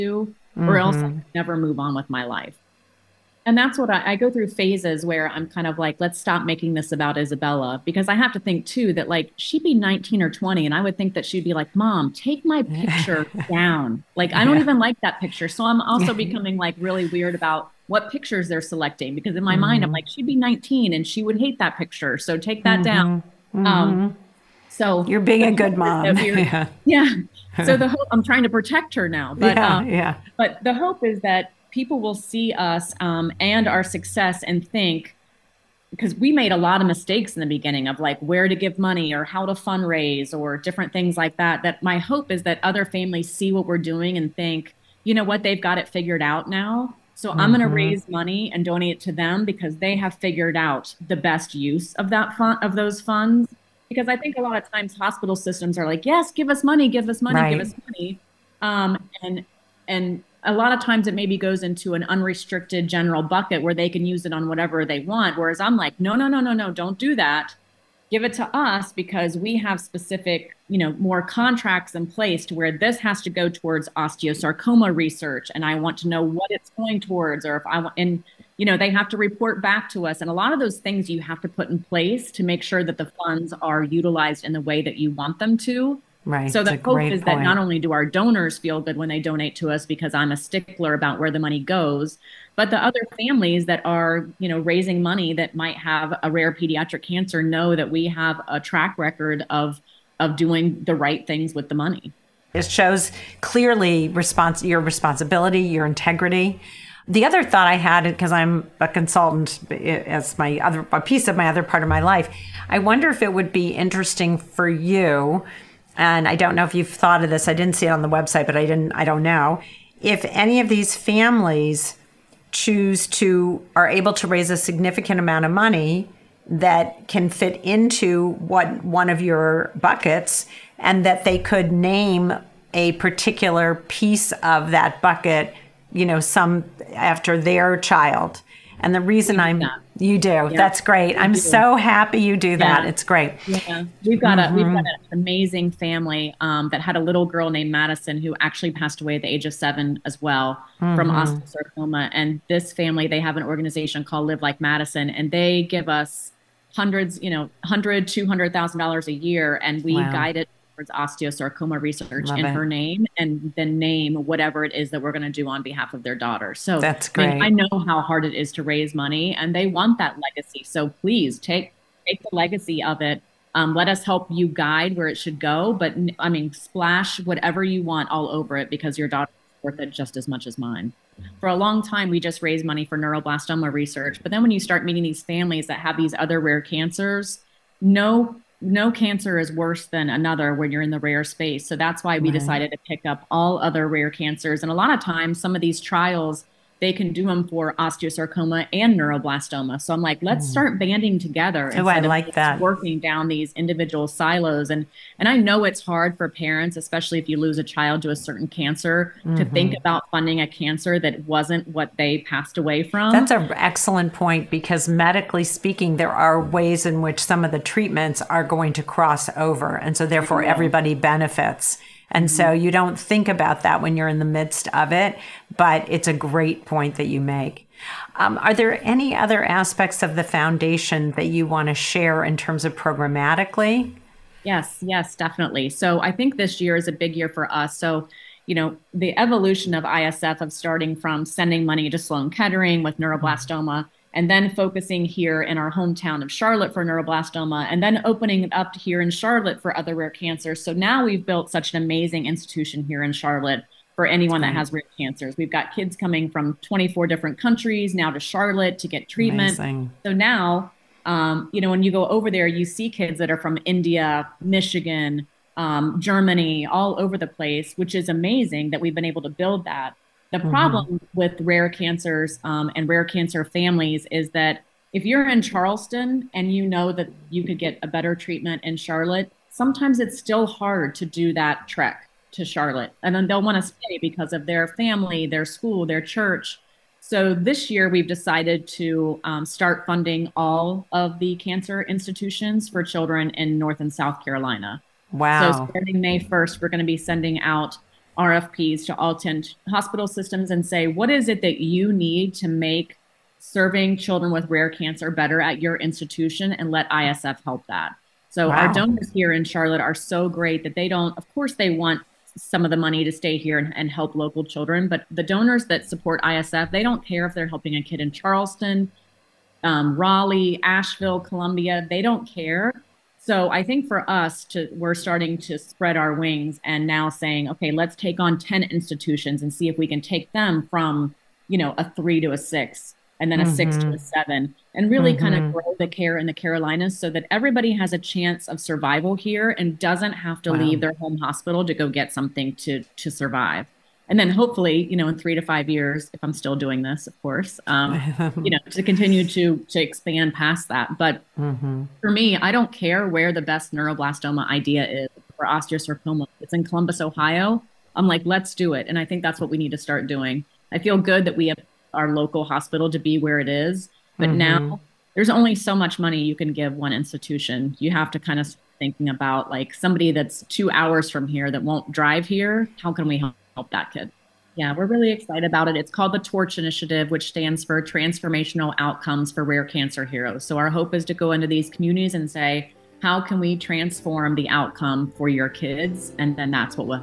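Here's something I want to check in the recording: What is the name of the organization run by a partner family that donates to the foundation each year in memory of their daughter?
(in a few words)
Live Like Madison.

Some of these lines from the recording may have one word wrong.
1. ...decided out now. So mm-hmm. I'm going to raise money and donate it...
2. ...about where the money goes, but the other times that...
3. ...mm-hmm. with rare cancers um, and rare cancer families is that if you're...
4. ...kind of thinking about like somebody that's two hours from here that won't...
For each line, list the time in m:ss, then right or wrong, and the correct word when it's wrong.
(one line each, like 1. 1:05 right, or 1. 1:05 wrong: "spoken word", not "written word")
1. 0:45 wrong: "figured", not "decided"
2. 1:30 wrong: "families", not "times"
3. 4:30 right
4. 6:08 right.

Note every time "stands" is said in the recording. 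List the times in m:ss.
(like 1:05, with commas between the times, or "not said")
6:17.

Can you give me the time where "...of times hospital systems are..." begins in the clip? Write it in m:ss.
0:54.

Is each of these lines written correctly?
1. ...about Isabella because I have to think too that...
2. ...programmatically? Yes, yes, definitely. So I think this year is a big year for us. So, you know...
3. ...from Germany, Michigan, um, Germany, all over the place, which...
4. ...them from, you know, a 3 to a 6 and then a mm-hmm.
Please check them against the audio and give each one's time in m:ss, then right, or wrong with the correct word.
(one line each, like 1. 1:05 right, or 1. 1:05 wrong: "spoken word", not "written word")
1. 0:06 right
2. 3:52 right
3. 4:23 wrong: "India", not "Germany"
4. 5:30 right.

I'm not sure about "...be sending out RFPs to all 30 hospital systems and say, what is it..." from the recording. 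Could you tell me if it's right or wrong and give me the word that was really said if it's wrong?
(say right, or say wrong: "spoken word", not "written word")
wrong: "10", not "30".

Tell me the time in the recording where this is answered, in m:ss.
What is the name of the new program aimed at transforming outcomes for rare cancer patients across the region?
6:16.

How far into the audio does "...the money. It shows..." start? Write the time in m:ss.
1:41.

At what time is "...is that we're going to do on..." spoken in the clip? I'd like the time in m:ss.
2:44.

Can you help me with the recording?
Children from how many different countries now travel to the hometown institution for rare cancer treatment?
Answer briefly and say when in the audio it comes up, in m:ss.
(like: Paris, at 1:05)
24, at 4:16.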